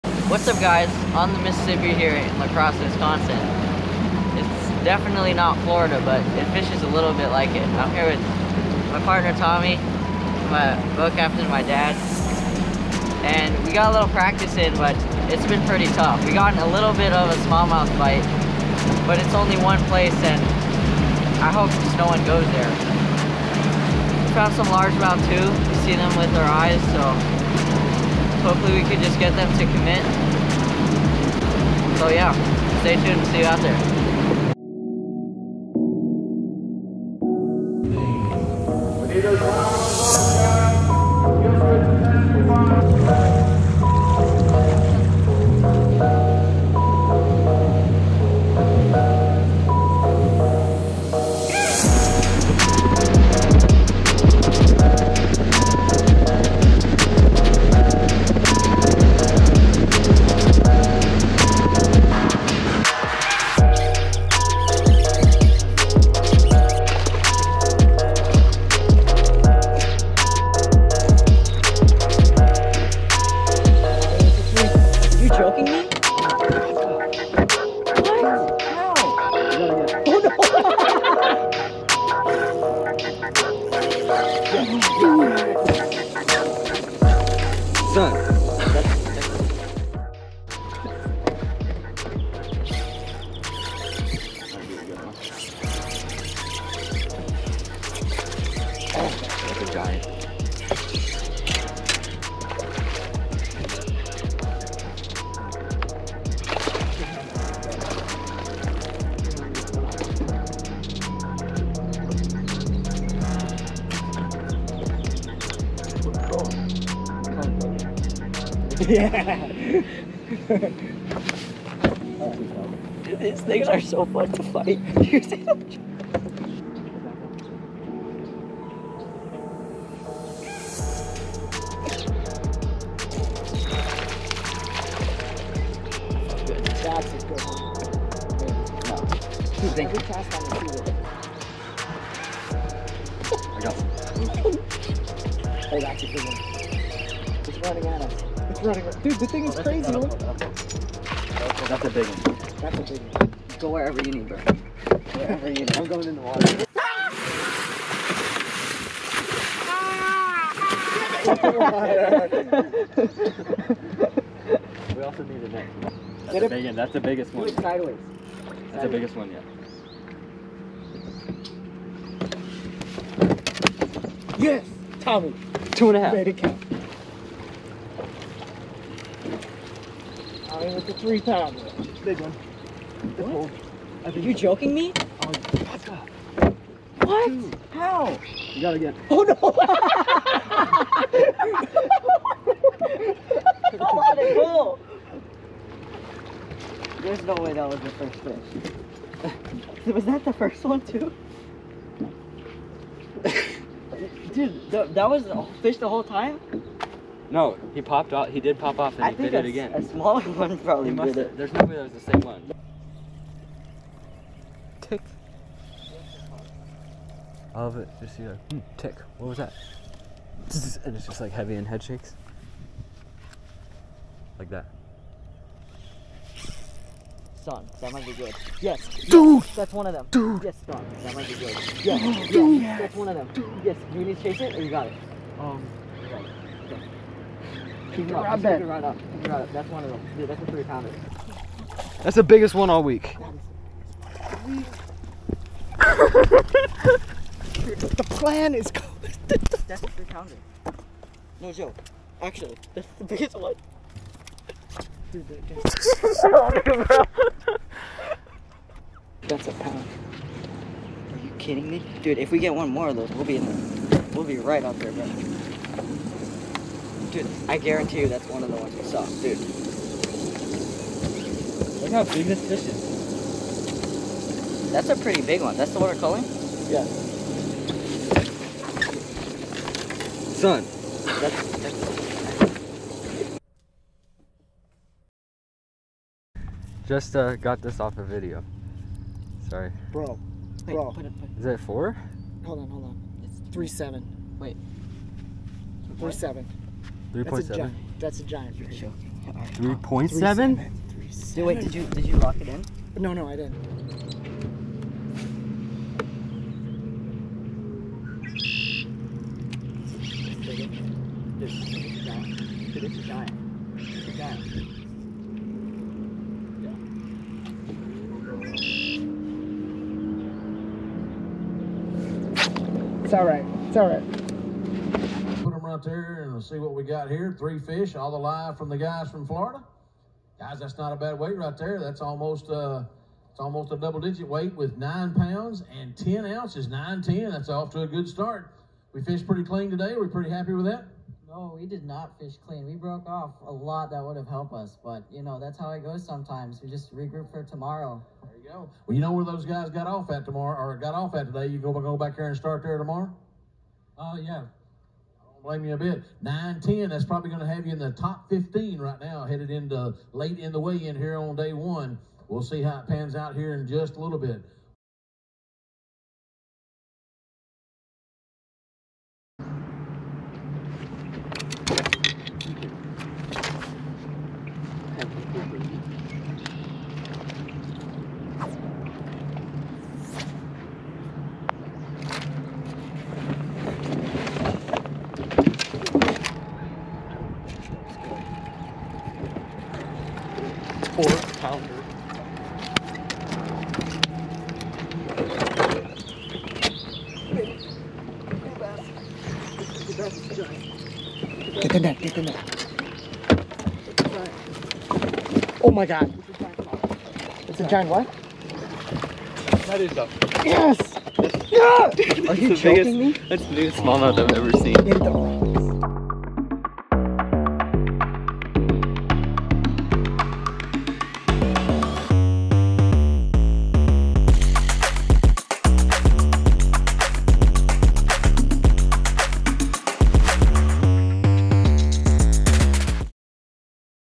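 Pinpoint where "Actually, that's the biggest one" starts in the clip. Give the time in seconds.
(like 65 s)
252 s.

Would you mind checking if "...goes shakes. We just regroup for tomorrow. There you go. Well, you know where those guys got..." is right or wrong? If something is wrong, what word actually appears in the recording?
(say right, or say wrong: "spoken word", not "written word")
wrong: "sometimes", not "shakes".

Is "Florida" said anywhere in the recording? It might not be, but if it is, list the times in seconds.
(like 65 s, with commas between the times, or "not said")
5 s, 329 s.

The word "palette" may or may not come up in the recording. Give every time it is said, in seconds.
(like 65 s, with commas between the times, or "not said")
not said.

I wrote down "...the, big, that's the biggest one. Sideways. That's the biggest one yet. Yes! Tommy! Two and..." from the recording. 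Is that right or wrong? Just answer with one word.
right.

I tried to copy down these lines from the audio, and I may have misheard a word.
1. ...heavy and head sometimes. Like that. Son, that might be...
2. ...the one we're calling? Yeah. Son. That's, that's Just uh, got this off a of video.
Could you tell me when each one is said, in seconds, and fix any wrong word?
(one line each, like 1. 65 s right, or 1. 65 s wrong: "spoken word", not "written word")
1. 221 s wrong: "shakes", not "sometimes"
2. 275 s right.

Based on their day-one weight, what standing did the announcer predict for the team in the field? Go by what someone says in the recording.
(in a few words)
top 15.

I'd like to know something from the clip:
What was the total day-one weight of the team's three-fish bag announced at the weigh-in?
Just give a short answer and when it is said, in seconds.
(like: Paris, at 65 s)
9 pounds 10 ounces, at 334 s.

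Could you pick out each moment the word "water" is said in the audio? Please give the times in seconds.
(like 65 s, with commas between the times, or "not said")
156 s, 161 s.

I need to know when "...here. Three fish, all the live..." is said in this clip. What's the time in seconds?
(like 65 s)
327 s.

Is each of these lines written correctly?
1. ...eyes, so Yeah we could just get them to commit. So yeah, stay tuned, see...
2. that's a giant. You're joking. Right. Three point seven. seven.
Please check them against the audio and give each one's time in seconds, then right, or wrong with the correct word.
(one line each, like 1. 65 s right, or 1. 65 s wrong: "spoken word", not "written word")
1. 26 s wrong: "Hopefully", not "Yeah"
2. 297 s right.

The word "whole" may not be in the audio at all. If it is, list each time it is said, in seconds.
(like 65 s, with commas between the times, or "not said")
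205 s.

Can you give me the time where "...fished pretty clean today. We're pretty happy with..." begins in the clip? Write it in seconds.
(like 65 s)
339 s.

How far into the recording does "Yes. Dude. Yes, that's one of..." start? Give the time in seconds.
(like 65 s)
231 s.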